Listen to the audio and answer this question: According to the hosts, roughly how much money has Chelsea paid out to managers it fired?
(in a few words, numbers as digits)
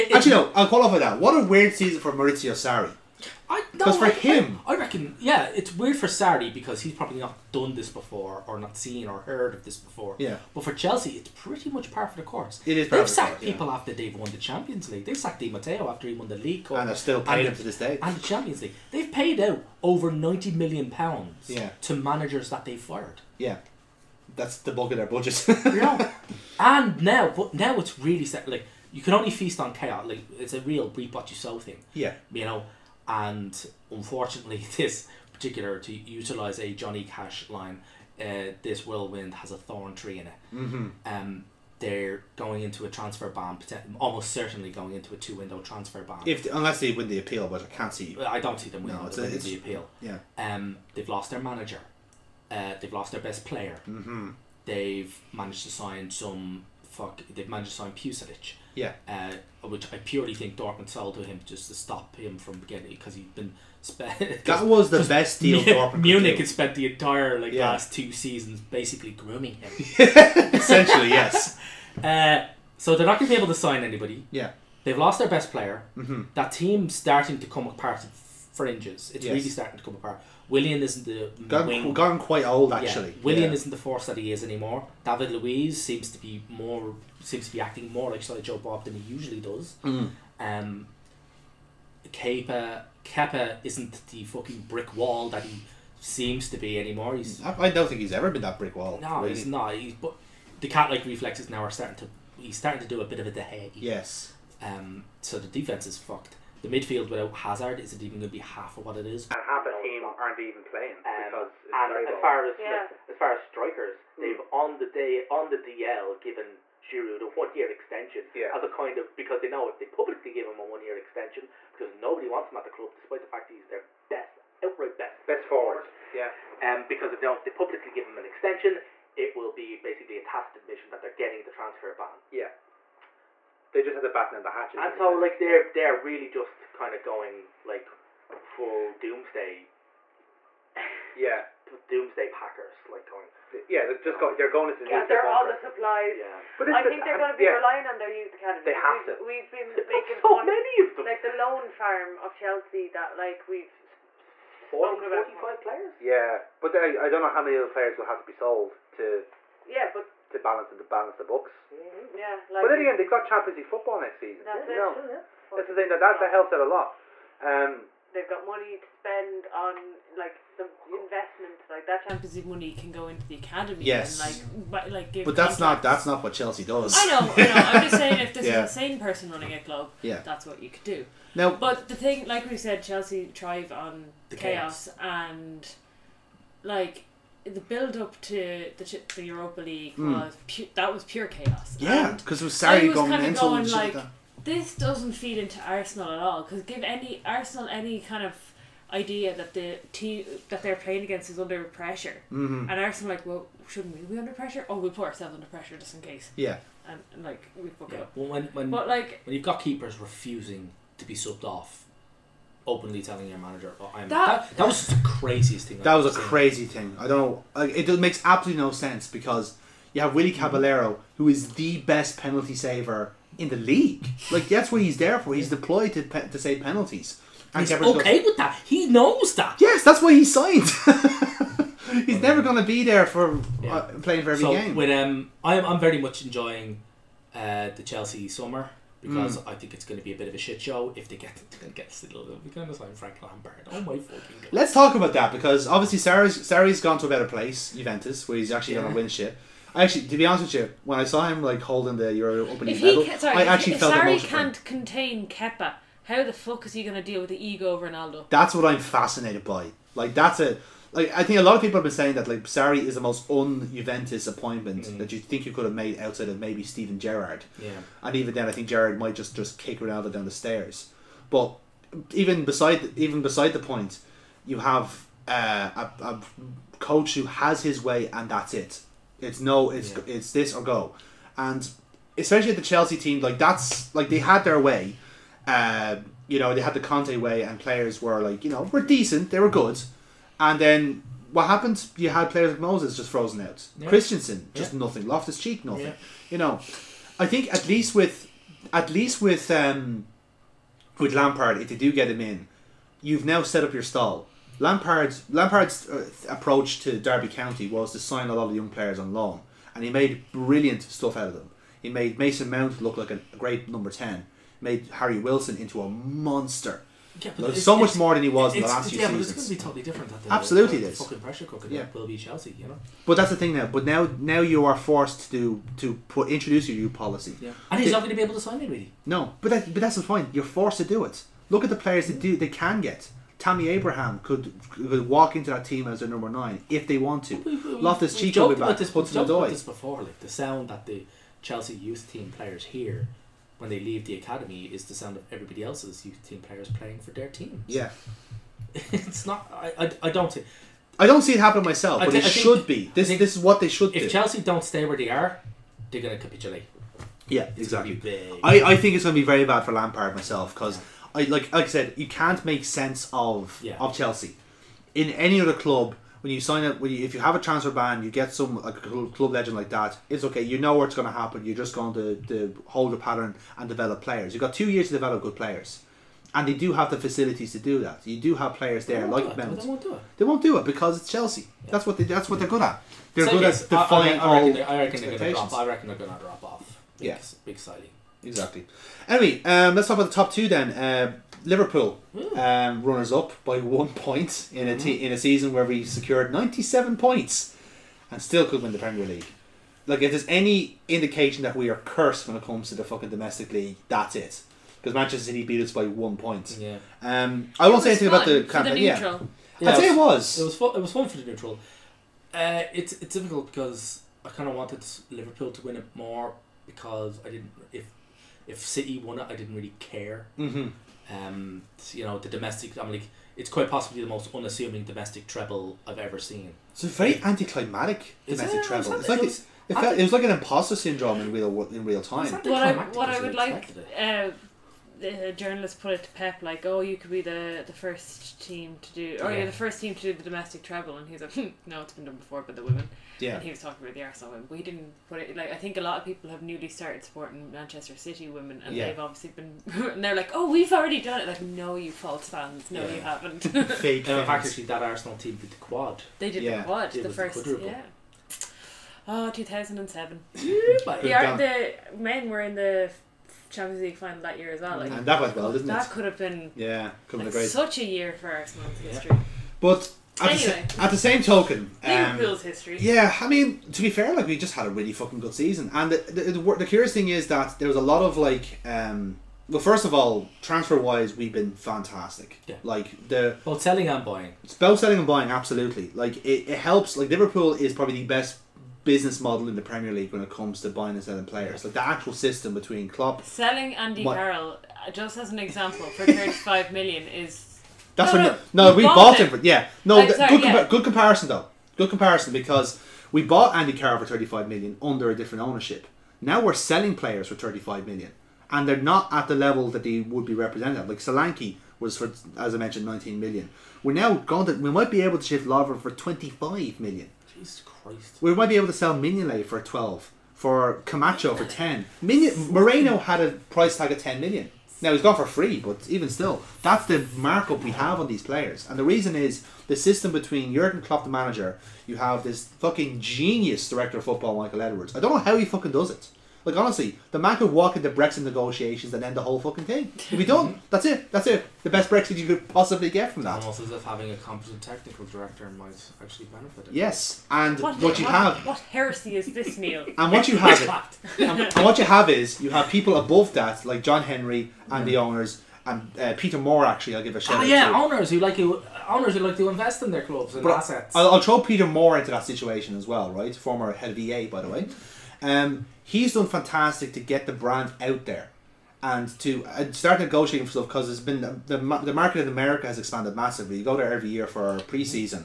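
over 90 million pounds.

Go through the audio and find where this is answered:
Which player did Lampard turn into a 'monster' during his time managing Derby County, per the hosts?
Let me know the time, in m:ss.
5:14.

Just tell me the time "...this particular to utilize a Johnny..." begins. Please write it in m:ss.
0:34.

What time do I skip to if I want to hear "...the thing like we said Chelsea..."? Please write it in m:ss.
3:01.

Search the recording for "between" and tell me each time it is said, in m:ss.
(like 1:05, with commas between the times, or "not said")
8:12, 8:50.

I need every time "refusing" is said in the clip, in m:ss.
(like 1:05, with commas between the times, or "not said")
3:29.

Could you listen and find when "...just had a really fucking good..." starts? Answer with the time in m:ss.
7:54.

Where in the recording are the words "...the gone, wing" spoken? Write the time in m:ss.
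1:21.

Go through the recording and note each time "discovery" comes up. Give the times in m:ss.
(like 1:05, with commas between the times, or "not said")
not said.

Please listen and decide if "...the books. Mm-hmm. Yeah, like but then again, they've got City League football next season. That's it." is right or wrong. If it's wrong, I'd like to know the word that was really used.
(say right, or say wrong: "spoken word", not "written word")
wrong: "Champions", not "City".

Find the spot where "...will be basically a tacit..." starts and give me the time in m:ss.
2:09.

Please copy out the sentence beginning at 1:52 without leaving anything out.
like, as far as strikers, hmm.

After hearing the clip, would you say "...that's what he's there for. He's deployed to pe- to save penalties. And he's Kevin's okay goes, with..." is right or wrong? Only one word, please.
right.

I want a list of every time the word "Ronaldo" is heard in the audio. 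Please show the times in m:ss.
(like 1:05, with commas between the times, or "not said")
4:17, 4:29.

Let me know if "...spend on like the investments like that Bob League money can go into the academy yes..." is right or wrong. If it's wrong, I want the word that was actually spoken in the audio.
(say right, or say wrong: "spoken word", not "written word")
wrong: "Champions", not "Bob".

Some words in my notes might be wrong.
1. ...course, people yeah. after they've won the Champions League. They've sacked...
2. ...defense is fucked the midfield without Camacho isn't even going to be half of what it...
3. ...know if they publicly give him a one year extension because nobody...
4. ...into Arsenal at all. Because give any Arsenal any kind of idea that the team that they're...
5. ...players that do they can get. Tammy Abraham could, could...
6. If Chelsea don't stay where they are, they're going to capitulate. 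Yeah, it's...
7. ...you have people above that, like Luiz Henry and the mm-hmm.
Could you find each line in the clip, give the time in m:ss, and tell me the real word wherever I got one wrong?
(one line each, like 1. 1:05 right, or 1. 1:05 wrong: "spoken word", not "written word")
1. 0:13 right
2. 1:45 wrong: "Hazard", not "Camacho"
3. 1:59 right
4. 3:15 right
5. 5:31 right
6. 5:54 right
7. 9:12 wrong: "John", not "Luiz".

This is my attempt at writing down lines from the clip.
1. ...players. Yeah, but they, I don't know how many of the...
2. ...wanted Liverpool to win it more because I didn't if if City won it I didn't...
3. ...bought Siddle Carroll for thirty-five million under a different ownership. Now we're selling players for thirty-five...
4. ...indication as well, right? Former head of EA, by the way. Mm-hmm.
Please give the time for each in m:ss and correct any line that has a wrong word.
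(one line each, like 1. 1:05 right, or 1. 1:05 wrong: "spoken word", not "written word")
1. 2:35 right
2. 6:54 right
3. 8:23 wrong: "Andy", not "Siddle"
4. 9:22 wrong: "situation", not "indication".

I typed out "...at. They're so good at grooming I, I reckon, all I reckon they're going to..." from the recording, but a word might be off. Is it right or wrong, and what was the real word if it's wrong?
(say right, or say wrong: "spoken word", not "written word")
wrong: "defying", not "grooming".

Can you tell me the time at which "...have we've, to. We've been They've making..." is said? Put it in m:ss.
2:28.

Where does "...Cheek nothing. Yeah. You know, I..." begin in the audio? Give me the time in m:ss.
4:55.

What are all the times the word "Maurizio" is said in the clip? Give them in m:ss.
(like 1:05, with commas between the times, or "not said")
0:02.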